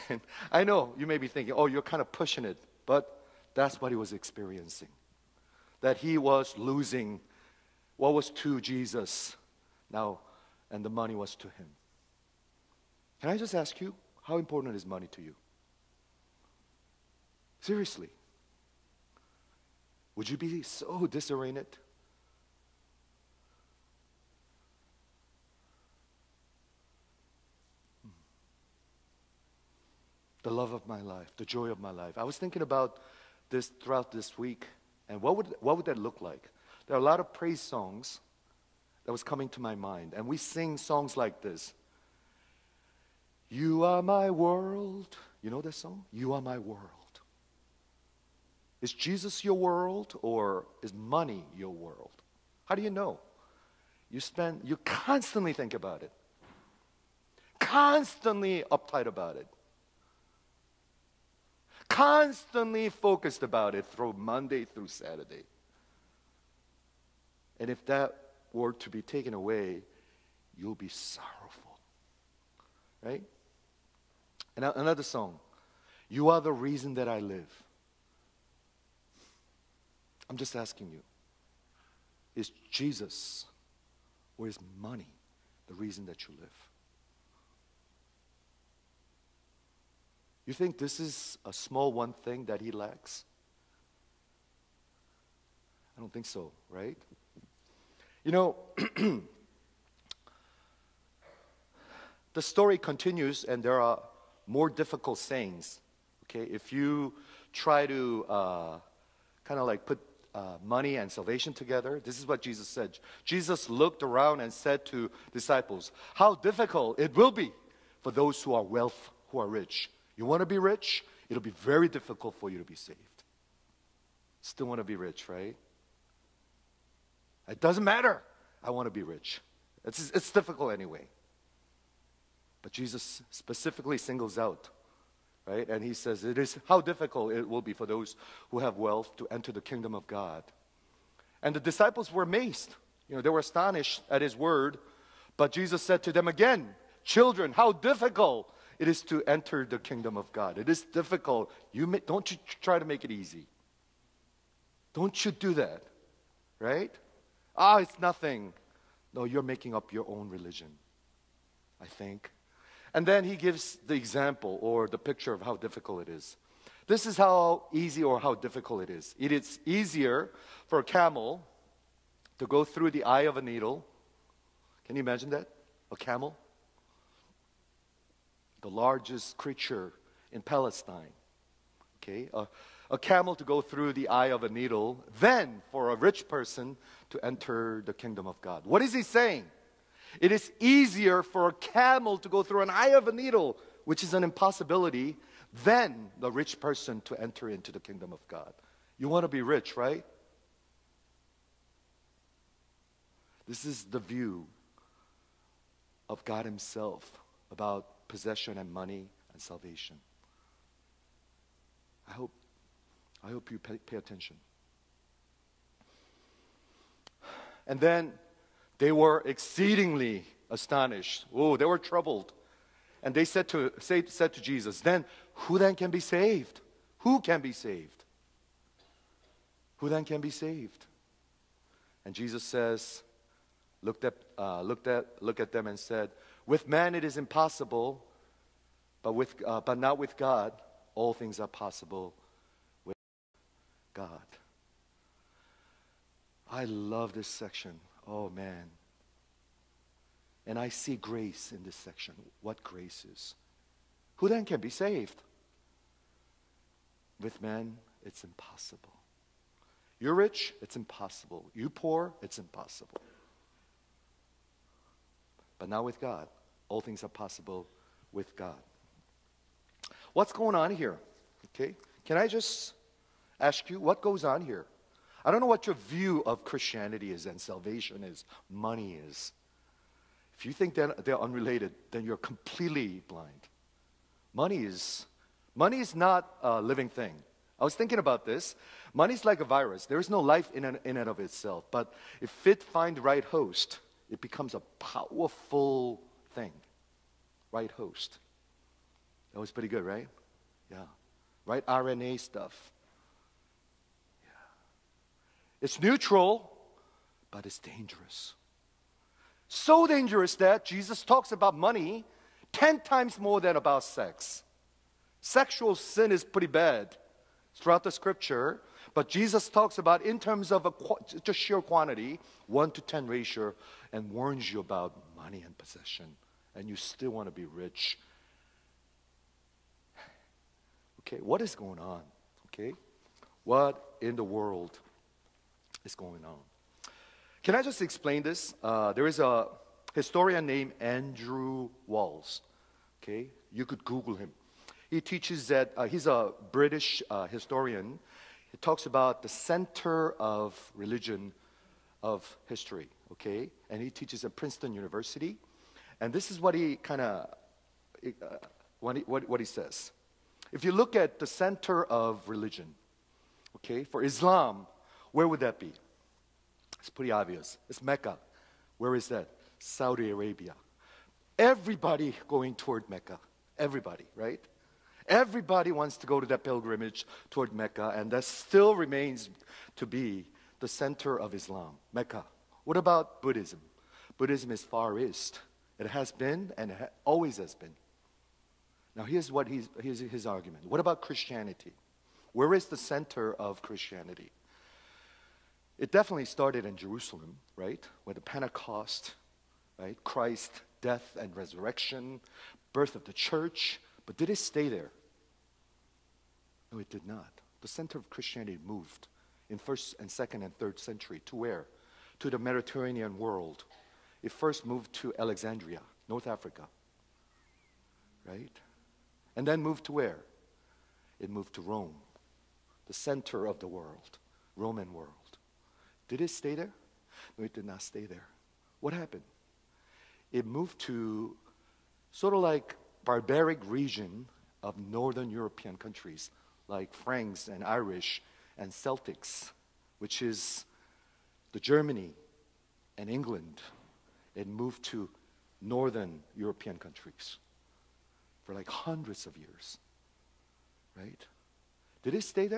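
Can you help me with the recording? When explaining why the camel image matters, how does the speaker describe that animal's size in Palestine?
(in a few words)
The largest creature.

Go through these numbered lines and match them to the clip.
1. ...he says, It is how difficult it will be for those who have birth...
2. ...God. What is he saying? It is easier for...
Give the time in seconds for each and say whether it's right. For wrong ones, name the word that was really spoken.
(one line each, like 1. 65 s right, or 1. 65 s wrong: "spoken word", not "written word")
1. 135 s wrong: "wealth", not "birth"
2. 188 s right.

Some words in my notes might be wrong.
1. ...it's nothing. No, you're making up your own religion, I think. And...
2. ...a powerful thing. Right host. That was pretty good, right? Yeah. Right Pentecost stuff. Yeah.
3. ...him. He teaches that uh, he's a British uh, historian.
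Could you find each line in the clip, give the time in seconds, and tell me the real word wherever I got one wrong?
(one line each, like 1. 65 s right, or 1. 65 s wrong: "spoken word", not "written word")
1. 157 s right
2. 294 s wrong: "RNA", not "Pentecost"
3. 344 s right.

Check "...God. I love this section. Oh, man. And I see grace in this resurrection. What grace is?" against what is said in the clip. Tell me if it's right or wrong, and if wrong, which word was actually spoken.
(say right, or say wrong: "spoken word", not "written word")
wrong: "section", not "resurrection".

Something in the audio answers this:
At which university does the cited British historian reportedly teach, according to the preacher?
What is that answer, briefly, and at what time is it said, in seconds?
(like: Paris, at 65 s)
Princeton University, at 354 s.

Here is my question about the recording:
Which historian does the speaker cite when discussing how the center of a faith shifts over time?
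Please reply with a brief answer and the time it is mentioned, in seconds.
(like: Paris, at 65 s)
Andrew Walls, at 340 s.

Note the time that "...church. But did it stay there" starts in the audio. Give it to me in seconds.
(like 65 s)
403 s.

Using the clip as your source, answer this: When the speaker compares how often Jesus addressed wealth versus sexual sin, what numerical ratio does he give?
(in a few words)
1 to 10.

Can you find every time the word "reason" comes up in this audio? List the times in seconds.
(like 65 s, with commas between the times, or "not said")
76 s, 85 s.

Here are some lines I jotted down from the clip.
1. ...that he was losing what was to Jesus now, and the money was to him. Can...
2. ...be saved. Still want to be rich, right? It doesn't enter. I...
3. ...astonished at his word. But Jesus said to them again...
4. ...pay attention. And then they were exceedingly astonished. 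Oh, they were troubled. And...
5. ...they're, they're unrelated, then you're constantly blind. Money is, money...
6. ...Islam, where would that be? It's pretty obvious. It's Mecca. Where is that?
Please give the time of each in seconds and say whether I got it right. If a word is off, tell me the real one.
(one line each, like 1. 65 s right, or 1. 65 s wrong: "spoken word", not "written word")
1. 5 s right
2. 122 s wrong: "matter", not "enter"
3. 143 s right
4. 213 s right
5. 280 s wrong: "completely", not "constantly"
6. 364 s right.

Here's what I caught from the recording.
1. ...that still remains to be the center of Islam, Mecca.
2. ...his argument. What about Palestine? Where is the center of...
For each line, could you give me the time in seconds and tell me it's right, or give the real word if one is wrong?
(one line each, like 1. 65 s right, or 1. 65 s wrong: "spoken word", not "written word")
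1. 378 s right
2. 389 s wrong: "Christianity", not "Palestine".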